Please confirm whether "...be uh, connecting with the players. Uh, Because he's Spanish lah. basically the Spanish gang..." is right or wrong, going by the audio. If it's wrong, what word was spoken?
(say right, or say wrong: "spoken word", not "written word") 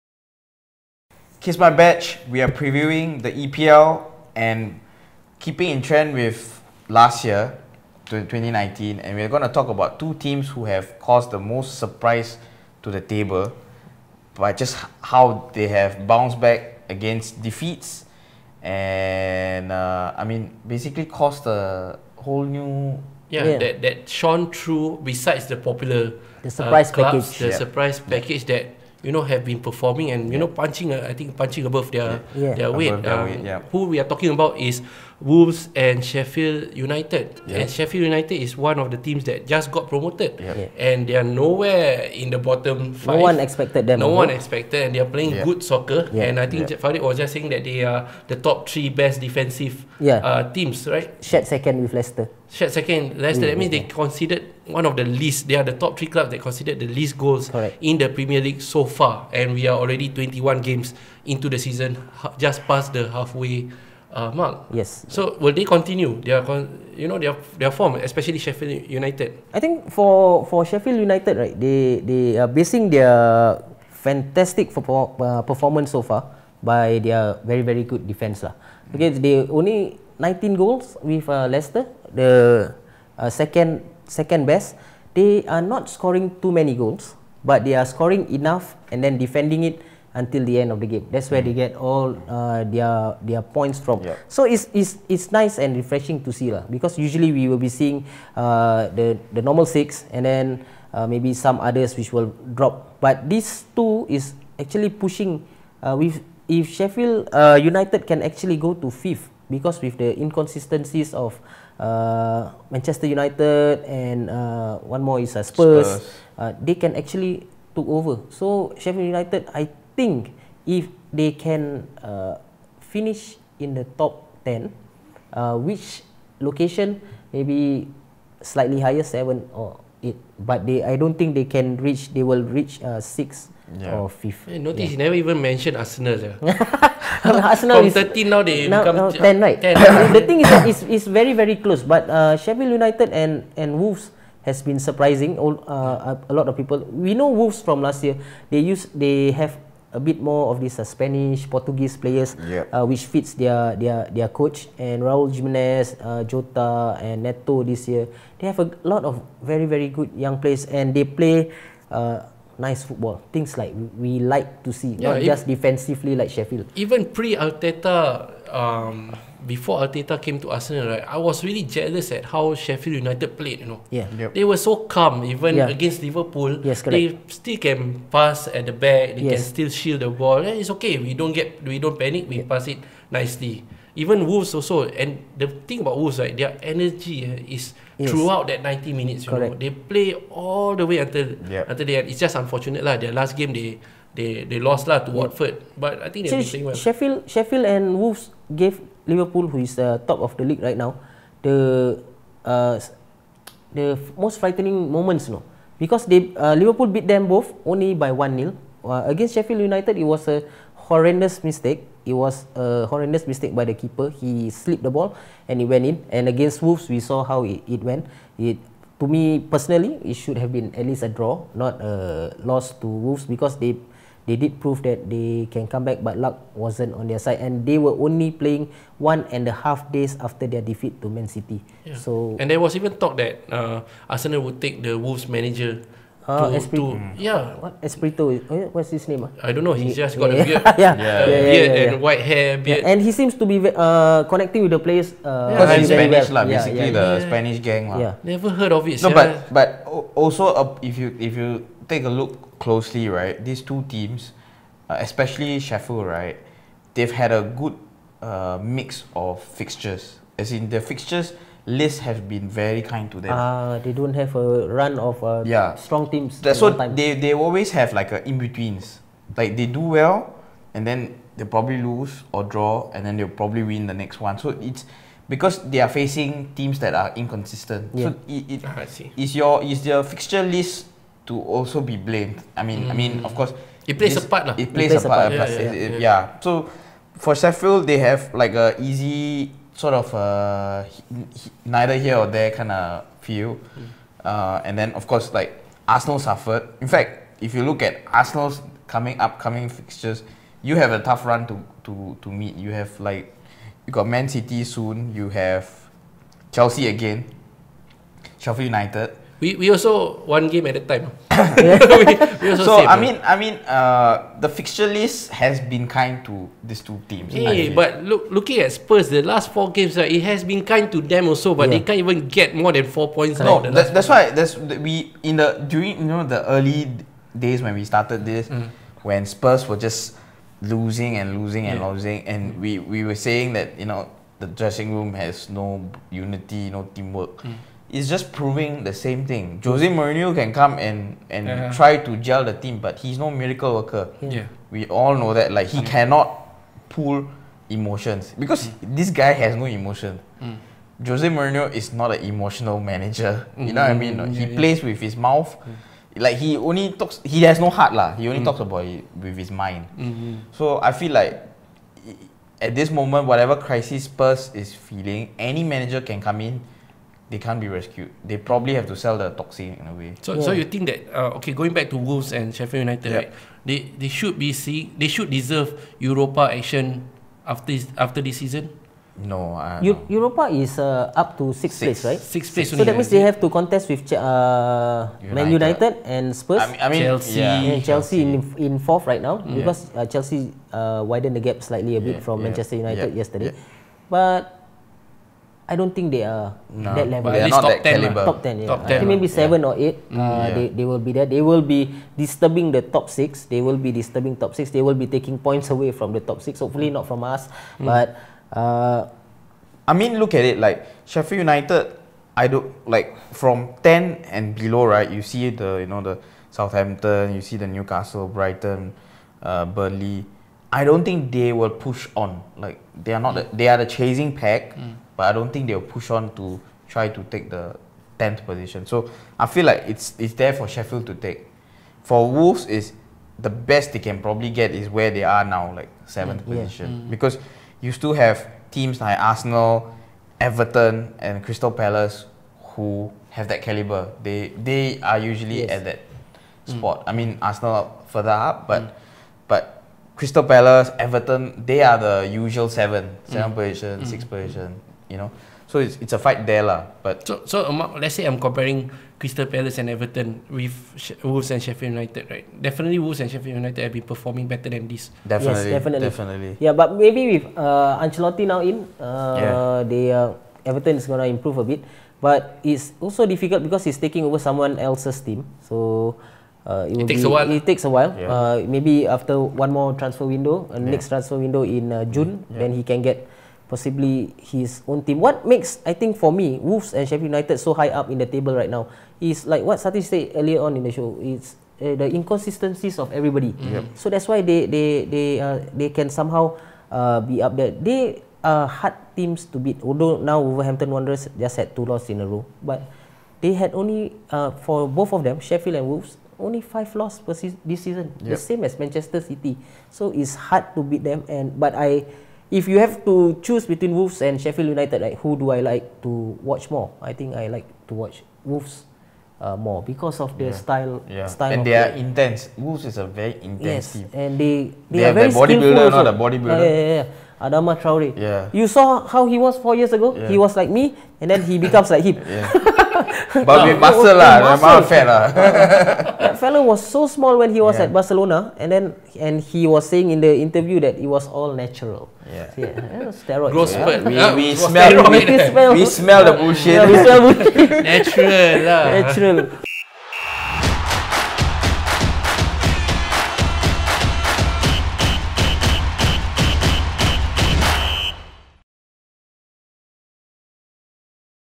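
right.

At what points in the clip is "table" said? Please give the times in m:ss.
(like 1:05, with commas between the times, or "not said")
0:13, 8:08.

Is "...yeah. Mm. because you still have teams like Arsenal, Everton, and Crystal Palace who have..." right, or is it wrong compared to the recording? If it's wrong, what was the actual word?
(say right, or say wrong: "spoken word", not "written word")
right.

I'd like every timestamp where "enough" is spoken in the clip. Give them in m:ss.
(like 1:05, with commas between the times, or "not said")
1:28.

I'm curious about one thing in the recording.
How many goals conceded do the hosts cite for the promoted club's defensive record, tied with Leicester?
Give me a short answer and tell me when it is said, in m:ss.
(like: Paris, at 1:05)
19, at 1:20.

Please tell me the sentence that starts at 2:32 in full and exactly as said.
uh, which fits their their their coach and Raul Jimenez, uh, Jota and Neto this year.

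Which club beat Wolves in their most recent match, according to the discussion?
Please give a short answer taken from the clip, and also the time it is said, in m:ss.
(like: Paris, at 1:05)
Watford, at 3:15.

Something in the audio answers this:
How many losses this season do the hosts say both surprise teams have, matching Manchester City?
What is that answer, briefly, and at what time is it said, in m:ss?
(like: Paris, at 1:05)
5, at 8:26.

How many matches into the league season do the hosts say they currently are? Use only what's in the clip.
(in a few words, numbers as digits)
21.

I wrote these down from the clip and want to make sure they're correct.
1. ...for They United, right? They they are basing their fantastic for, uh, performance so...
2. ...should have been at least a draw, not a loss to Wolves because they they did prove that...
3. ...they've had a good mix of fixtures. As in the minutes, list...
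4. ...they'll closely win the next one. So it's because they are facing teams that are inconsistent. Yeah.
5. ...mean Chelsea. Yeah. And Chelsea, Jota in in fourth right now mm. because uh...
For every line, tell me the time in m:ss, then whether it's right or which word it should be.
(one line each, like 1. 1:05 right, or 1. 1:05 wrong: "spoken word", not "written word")
1. 1:10 wrong: "Sheffield", not "They"
2. 3:40 right
3. 4:16 wrong: "fixtures", not "minutes"
4. 4:33 wrong: "probably", not "closely"
5. 6:26 wrong: "Chelsea", not "Jota".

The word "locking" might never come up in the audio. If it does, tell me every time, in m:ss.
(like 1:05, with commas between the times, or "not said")
not said.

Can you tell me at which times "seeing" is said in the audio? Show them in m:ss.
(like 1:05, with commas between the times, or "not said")
1:37, 6:14.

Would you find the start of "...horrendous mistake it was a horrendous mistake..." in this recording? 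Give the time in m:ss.
3:30.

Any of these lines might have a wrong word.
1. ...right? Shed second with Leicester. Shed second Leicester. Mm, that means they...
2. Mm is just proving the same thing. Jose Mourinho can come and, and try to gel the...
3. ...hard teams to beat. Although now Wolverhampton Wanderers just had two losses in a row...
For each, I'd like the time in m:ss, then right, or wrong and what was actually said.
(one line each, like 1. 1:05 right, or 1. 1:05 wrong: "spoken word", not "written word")
1. 0:50 right
2. 5:37 right
3. 8:18 right.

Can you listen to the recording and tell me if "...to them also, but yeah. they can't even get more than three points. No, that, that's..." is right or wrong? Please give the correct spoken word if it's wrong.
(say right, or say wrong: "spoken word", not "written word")
wrong: "four", not "three".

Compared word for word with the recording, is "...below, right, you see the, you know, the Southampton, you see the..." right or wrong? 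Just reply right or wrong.
right.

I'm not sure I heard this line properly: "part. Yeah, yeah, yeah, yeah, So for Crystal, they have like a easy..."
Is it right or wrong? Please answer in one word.
wrong.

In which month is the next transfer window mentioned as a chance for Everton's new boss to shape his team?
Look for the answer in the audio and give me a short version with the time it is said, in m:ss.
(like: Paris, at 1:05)
June, at 8:02.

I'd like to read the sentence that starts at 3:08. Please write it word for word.
Throughout that 90 minutes you know, They play all the way until yep.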